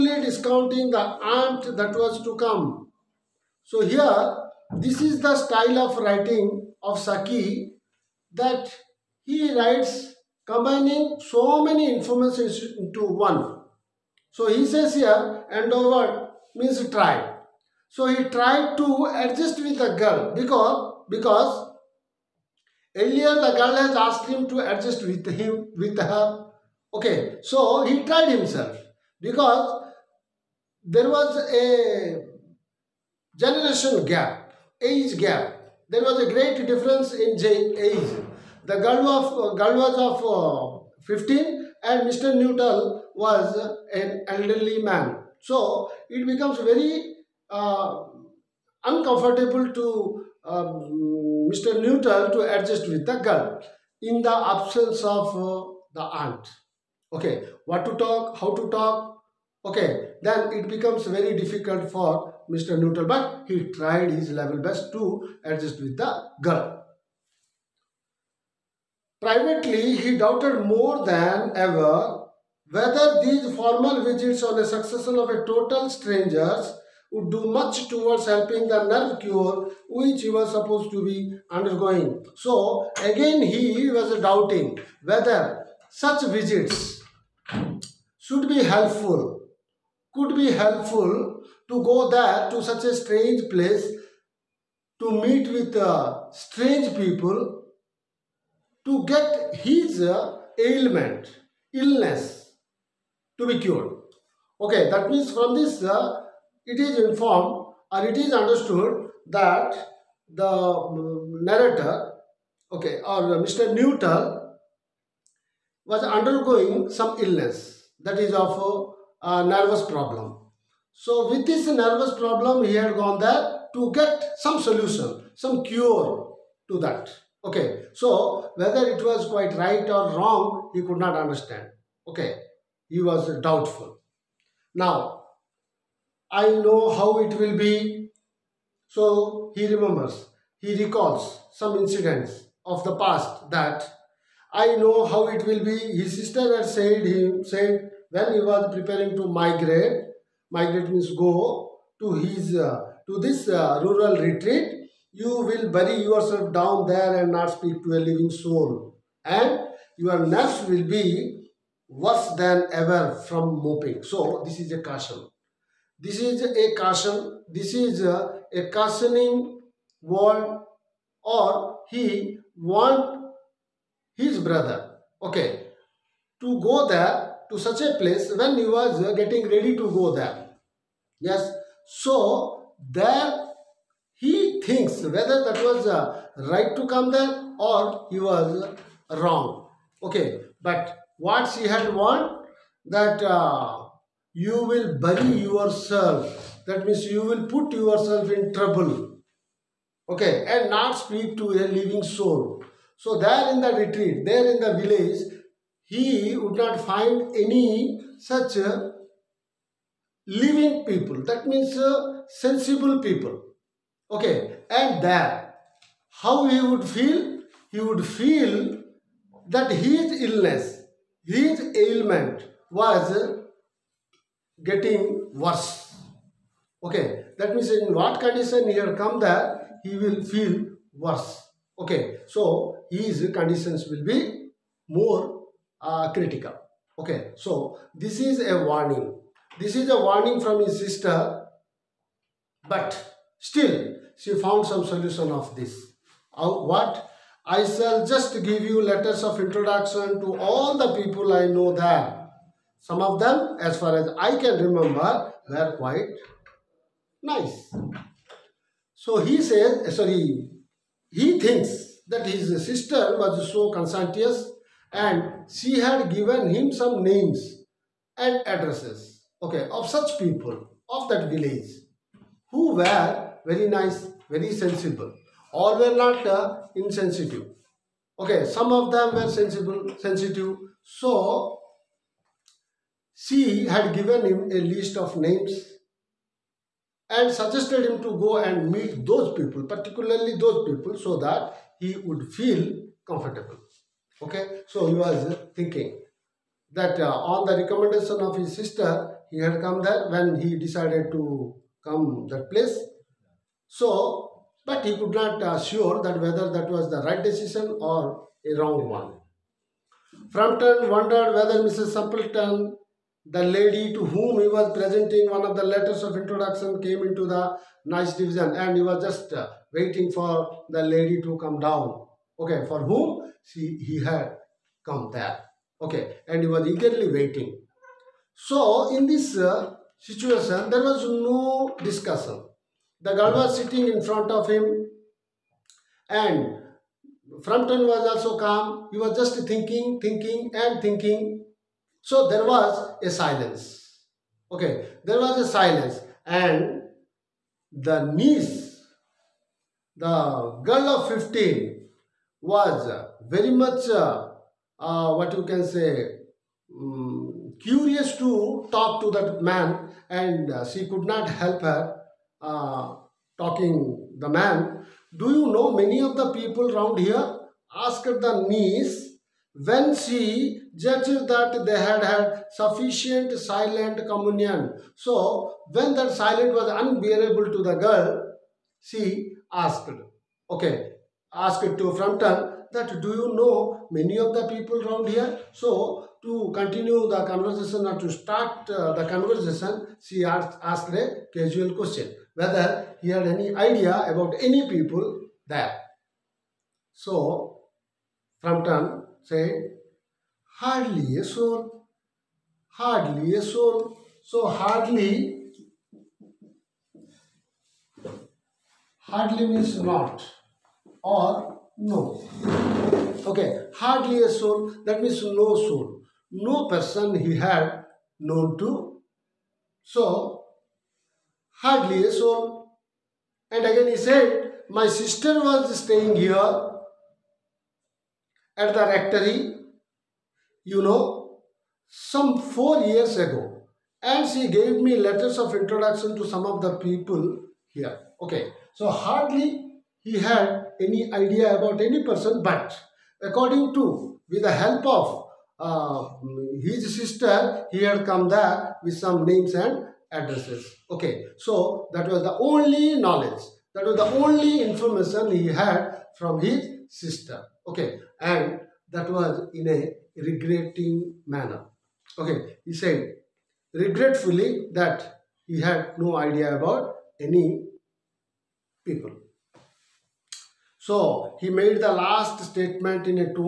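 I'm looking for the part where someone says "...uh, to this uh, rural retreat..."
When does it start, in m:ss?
2:32.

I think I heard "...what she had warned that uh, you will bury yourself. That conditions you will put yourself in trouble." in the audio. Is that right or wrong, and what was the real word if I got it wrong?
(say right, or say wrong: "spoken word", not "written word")
wrong: "means", not "conditions".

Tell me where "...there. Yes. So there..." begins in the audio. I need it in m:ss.
3:00.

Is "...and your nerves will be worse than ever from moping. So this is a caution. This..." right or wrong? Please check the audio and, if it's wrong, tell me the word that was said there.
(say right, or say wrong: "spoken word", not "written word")
right.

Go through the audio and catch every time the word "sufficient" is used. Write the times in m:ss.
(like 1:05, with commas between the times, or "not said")
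6:12.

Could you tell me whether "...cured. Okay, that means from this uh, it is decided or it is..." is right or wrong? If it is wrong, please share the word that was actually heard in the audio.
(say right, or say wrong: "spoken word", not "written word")
wrong: "informed", not "decided".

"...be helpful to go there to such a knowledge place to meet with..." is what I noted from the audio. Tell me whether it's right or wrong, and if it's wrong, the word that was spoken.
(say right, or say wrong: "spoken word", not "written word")
wrong: "strange", not "knowledge".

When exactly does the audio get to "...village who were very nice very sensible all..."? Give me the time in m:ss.
4:31.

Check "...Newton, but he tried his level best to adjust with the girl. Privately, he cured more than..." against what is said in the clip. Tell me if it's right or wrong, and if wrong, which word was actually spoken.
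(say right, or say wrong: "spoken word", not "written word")
wrong: "doubted", not "cured".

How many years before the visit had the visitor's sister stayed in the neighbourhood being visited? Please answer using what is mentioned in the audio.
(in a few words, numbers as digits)
4.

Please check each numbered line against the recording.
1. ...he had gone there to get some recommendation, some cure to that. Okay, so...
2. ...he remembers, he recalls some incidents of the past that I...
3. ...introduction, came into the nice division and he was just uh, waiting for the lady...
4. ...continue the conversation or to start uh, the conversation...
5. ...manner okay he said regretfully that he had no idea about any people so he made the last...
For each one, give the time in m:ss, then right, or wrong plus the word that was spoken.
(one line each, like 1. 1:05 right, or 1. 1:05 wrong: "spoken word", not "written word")
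1. 2:02 wrong: "solution", not "recommendation"
2. 2:19 right
3. 5:16 right
4. 6:26 right
5. 7:41 right.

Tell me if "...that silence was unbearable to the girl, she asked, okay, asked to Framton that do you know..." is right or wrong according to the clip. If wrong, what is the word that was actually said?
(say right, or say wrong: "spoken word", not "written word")
right.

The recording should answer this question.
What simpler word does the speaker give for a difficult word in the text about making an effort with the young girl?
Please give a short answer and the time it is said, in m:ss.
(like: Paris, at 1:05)
try, at 0:16.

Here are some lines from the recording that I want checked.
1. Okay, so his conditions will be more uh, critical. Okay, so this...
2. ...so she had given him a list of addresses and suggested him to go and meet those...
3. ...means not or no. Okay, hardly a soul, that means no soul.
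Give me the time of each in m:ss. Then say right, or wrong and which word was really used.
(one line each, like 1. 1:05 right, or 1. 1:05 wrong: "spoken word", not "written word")
1. 3:51 right
2. 4:40 wrong: "names", not "addresses"
3. 6:49 right.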